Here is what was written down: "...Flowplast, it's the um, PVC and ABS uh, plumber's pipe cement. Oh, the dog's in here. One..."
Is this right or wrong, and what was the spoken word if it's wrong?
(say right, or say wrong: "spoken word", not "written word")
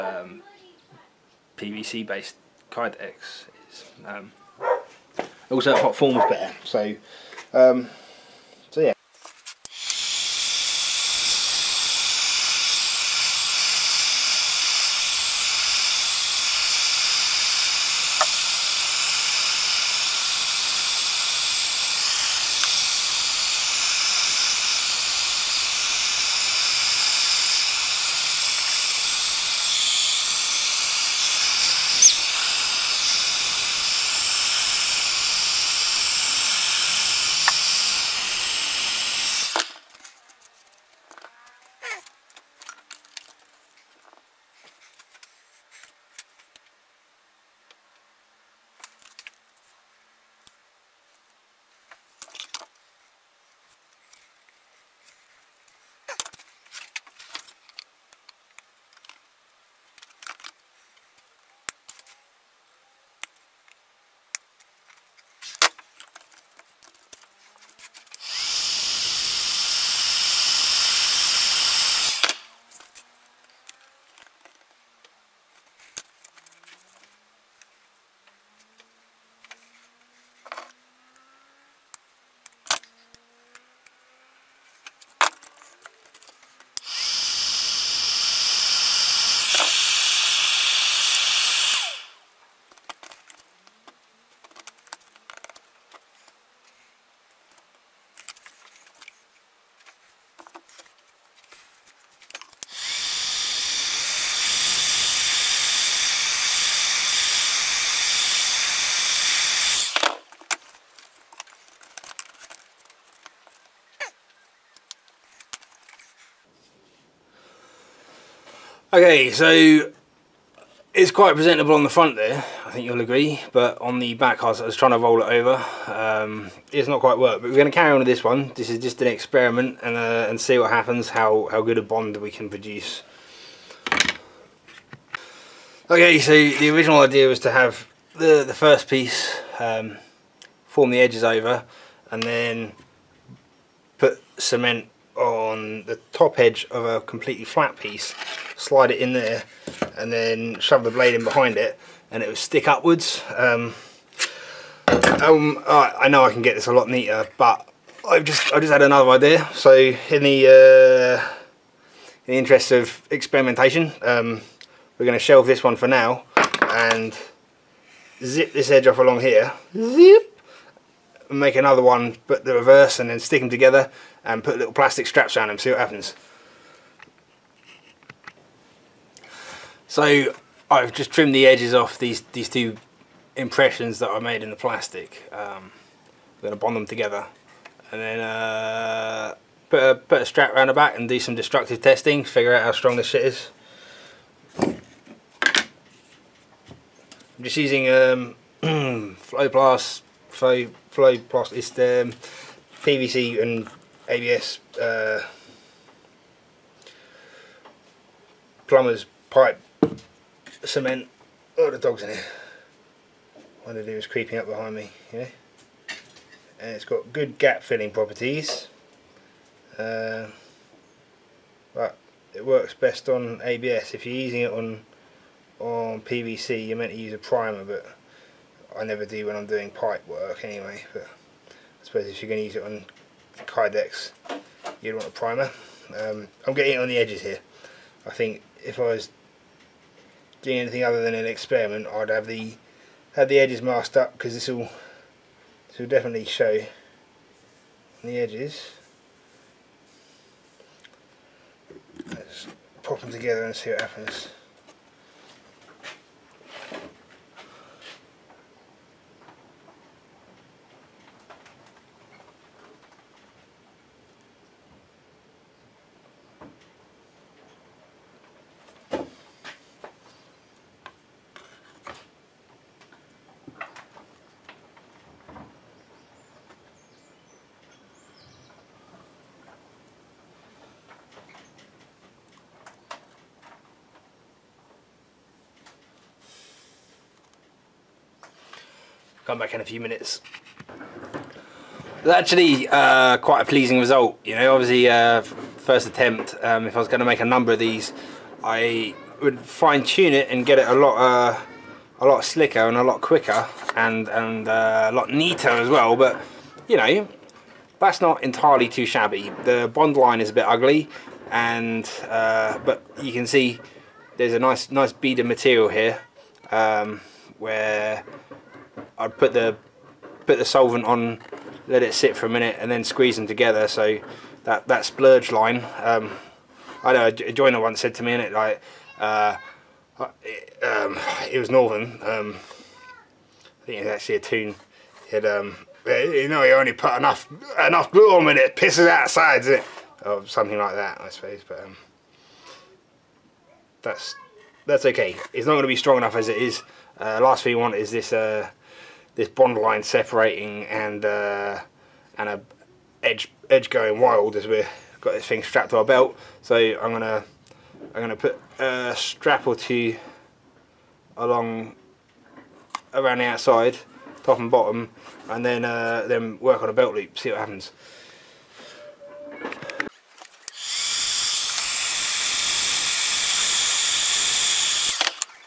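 right.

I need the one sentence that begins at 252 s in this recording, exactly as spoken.
Let's pop them together and see what happens.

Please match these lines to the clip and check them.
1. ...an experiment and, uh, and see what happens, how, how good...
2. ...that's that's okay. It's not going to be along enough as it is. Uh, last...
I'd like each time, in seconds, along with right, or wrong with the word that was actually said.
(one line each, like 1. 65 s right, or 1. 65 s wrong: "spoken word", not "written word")
1. 128 s right
2. 343 s wrong: "strong", not "along".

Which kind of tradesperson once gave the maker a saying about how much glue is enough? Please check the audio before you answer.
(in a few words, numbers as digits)
A joiner.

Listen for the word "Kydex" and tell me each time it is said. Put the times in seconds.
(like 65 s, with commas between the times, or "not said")
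2 s, 233 s.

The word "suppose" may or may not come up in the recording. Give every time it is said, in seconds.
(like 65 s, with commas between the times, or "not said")
231 s, 341 s.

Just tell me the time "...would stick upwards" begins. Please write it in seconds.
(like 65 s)
152 s.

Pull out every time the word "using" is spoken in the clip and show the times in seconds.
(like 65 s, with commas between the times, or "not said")
197 s, 224 s.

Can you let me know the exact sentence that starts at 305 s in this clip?
But you know, that's not entirely too shabby.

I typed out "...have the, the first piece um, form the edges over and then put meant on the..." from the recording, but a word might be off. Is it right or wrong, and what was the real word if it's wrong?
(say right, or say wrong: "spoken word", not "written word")
wrong: "cement", not "meant".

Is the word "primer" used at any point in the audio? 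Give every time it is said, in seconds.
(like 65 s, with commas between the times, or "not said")
227 s, 235 s.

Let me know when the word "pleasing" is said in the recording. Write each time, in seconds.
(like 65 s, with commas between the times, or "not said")
293 s.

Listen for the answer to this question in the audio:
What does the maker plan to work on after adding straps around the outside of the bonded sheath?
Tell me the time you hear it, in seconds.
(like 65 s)
366 s.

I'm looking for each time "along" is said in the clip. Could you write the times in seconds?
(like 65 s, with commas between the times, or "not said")
168 s, 361 s.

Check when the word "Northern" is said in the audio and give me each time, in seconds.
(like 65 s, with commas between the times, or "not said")
331 s.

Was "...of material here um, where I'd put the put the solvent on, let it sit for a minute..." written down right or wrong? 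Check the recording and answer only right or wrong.
right.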